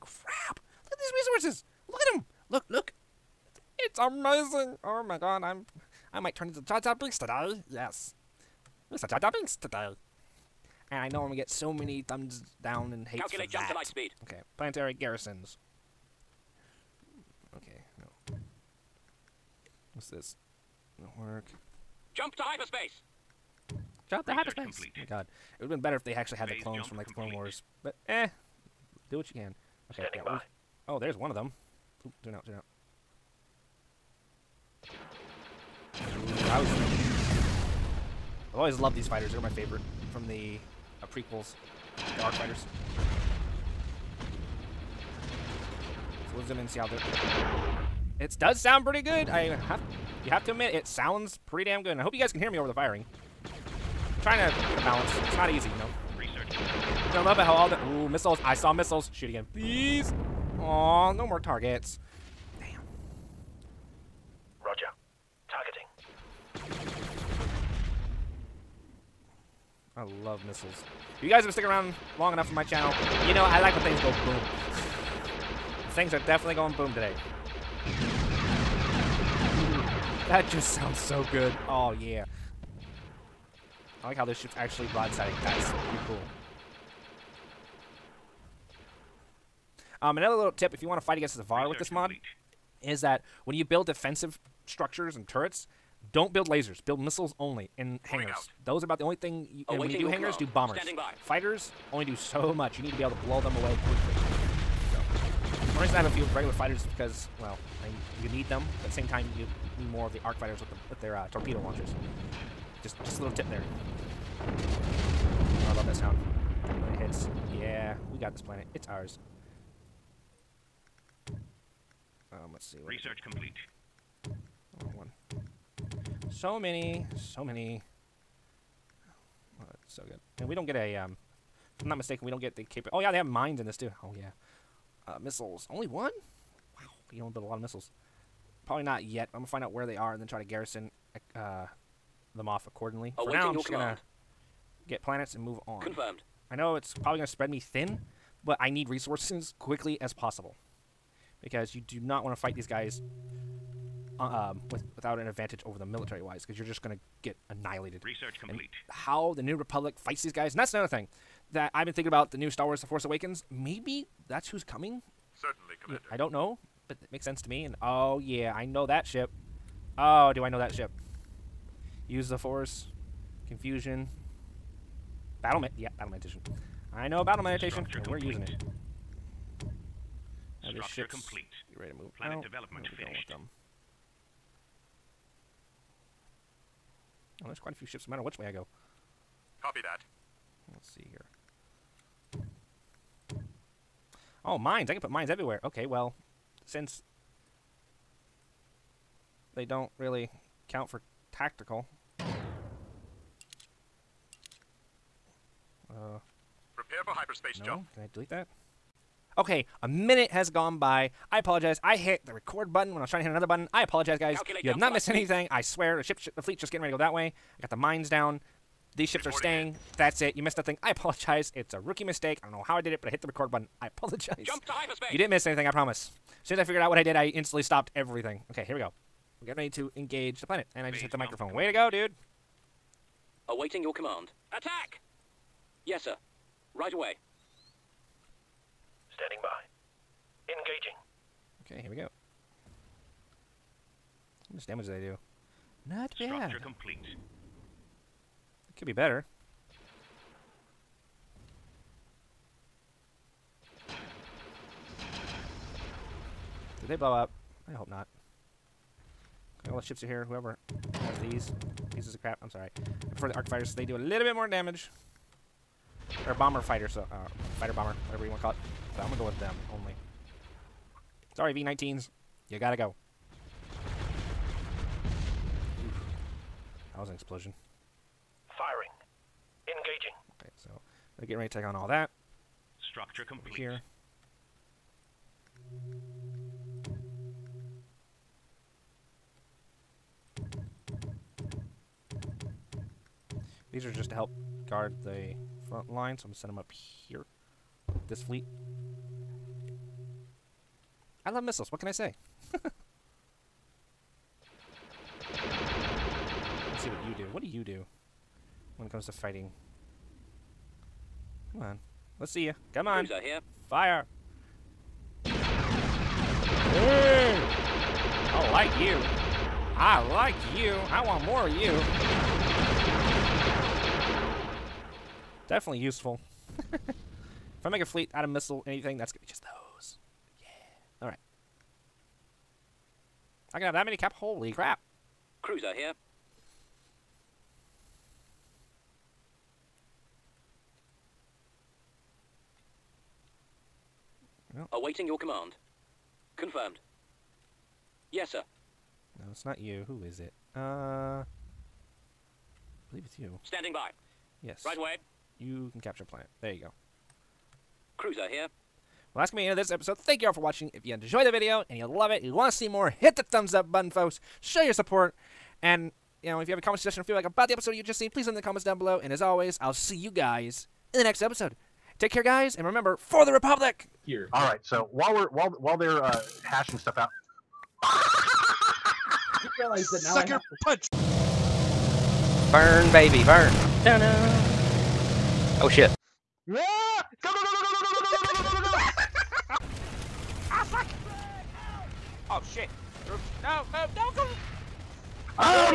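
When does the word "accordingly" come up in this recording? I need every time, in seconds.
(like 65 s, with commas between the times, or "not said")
142 s.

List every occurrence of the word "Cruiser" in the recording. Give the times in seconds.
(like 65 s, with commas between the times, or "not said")
335 s, 357 s.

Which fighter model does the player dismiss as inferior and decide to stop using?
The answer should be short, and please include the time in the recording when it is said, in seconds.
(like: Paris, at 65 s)
V19s, at 271 s.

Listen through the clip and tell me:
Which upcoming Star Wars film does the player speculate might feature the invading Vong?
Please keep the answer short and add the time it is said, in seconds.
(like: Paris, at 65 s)
The Force Awakens, at 162 s.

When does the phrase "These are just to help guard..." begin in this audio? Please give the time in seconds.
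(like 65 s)
293 s.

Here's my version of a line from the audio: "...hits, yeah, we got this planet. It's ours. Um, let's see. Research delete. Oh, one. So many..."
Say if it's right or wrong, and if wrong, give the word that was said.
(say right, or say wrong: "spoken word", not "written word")
wrong: "complete", not "delete".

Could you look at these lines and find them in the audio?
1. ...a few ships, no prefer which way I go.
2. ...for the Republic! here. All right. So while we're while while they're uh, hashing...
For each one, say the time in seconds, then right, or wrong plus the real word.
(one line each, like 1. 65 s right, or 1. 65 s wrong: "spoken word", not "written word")
1. 187 s wrong: "matter", not "prefer"
2. 372 s right.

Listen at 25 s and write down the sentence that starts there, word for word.
It would have been better if they actually had Phase the clones from like the Clone Wars.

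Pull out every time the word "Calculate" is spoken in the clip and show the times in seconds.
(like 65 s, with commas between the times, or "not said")
13 s, 214 s.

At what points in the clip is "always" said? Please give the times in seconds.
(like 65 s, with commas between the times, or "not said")
38 s, 369 s.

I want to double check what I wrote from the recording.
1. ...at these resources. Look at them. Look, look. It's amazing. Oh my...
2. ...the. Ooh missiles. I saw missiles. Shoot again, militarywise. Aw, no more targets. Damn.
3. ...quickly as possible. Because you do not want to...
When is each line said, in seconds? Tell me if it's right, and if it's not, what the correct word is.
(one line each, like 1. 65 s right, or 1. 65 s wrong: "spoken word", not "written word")
1. 0 s right
2. 57 s wrong: "please", not "militarywise"
3. 149 s right.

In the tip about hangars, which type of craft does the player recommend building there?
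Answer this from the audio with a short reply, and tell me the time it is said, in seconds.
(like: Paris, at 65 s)
Bombers, at 100 s.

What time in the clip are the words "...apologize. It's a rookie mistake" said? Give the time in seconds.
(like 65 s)
220 s.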